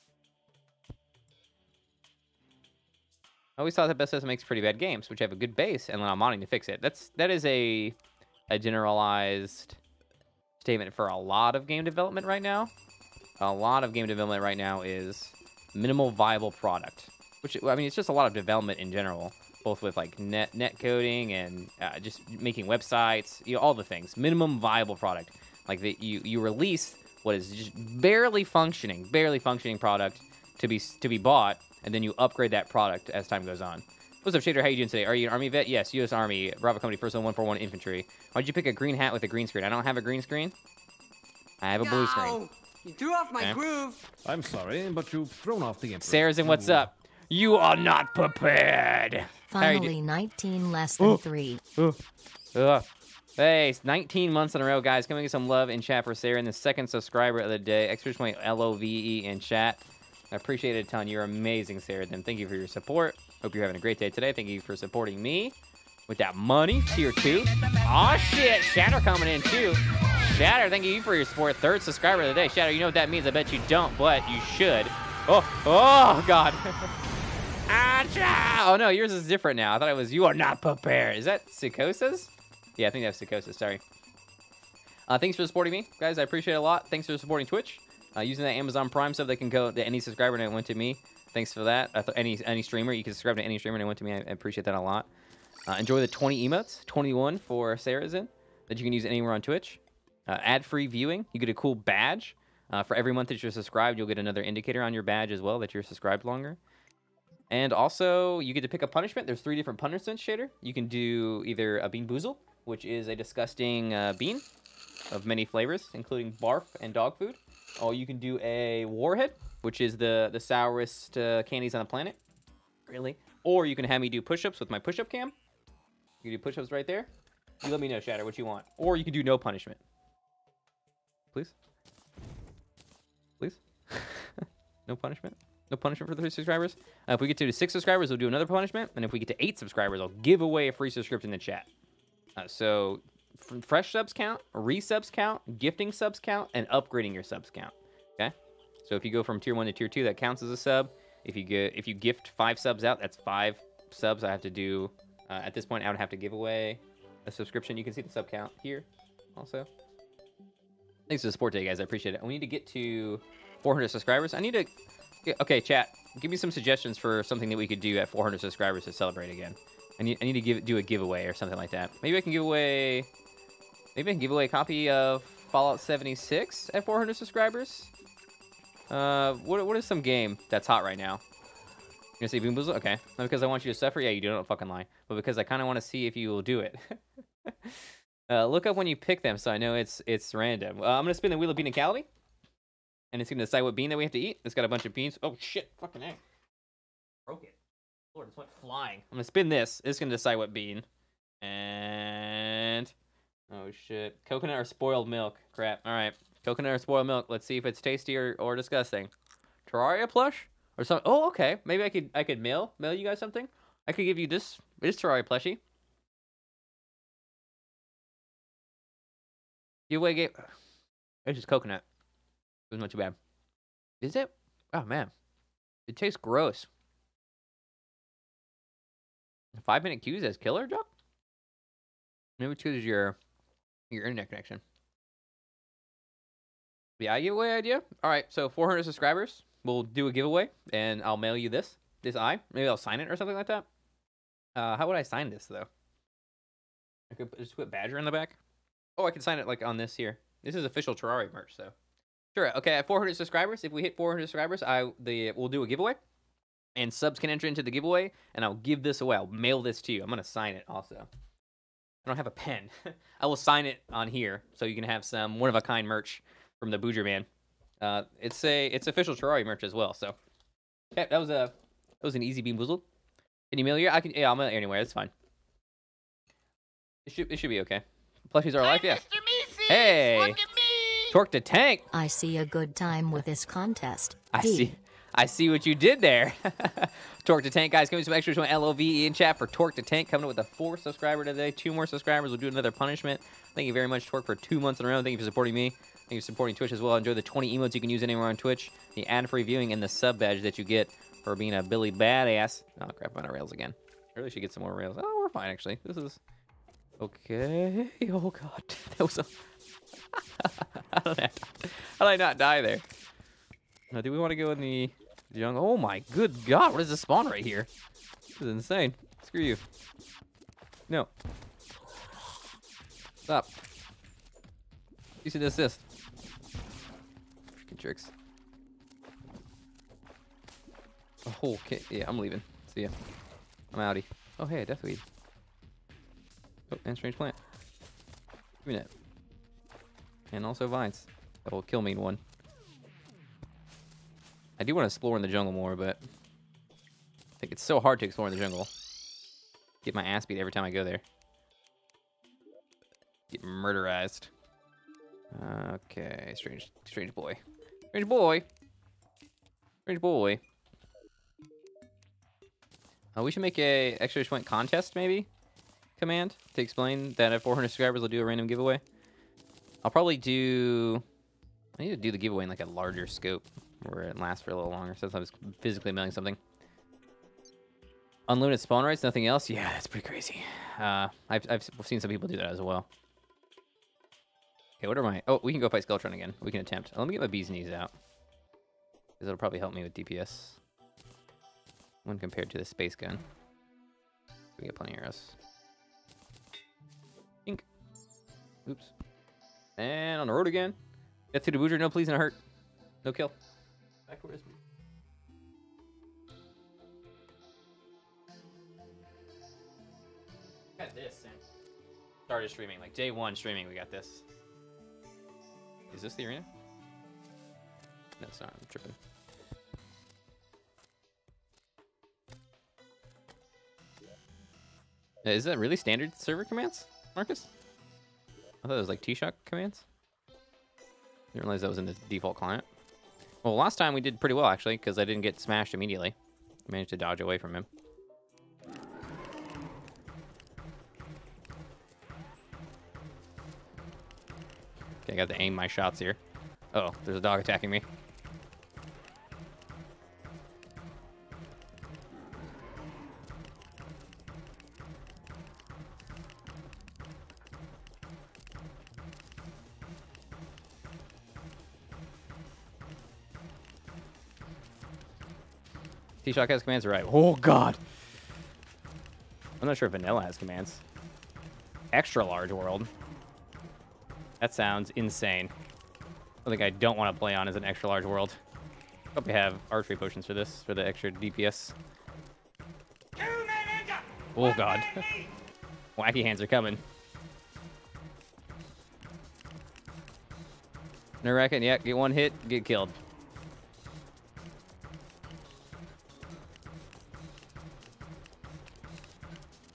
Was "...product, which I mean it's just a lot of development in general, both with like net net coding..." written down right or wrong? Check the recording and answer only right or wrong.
right.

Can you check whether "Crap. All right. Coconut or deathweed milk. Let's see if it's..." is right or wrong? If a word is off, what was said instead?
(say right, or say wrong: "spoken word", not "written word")
wrong: "spoiled", not "deathweed".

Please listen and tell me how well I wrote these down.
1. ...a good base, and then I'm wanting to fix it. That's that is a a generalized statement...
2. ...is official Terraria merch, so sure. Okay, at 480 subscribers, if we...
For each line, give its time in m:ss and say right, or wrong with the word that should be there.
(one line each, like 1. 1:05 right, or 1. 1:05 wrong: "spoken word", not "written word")
1. 0:05 right
2. 4:10 wrong: "400", not "480".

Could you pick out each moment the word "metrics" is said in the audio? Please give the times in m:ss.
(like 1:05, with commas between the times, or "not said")
not said.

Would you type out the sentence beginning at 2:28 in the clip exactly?
Okay, so if you go from tier one to tier two, that counts as a sub.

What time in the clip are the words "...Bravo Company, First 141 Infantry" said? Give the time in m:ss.
0:36.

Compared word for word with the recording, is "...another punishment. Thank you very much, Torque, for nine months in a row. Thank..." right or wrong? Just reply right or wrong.
wrong.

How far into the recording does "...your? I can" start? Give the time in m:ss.
4:33.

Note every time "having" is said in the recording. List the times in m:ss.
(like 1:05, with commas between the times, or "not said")
1:03.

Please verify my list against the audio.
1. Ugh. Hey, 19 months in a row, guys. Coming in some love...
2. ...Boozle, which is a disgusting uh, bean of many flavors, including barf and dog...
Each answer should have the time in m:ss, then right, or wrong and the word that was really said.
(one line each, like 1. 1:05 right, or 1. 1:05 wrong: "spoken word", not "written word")
1. 0:52 right
2. 1:52 right.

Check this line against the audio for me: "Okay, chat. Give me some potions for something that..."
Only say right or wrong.
wrong.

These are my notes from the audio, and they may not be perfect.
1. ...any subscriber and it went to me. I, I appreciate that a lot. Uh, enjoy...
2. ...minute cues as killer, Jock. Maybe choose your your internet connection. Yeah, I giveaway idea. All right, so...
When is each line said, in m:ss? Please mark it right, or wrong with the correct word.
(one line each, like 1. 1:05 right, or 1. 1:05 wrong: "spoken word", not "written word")
1. 1:33 wrong: "streamer", not "subscriber"
2. 3:49 right.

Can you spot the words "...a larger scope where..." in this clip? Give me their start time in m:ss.
6:12.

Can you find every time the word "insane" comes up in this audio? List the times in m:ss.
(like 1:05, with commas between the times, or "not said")
5:18, 7:54.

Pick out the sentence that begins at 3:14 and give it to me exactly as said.
It's got a bunch of beans.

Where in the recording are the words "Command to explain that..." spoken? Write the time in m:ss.
6:05.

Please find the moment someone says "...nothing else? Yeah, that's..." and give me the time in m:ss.
6:19.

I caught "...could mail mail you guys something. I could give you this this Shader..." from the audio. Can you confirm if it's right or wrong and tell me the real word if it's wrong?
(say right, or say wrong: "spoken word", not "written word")
wrong: "Terraria", not "Shader".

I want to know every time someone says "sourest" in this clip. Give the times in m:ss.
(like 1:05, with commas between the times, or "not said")
2:00.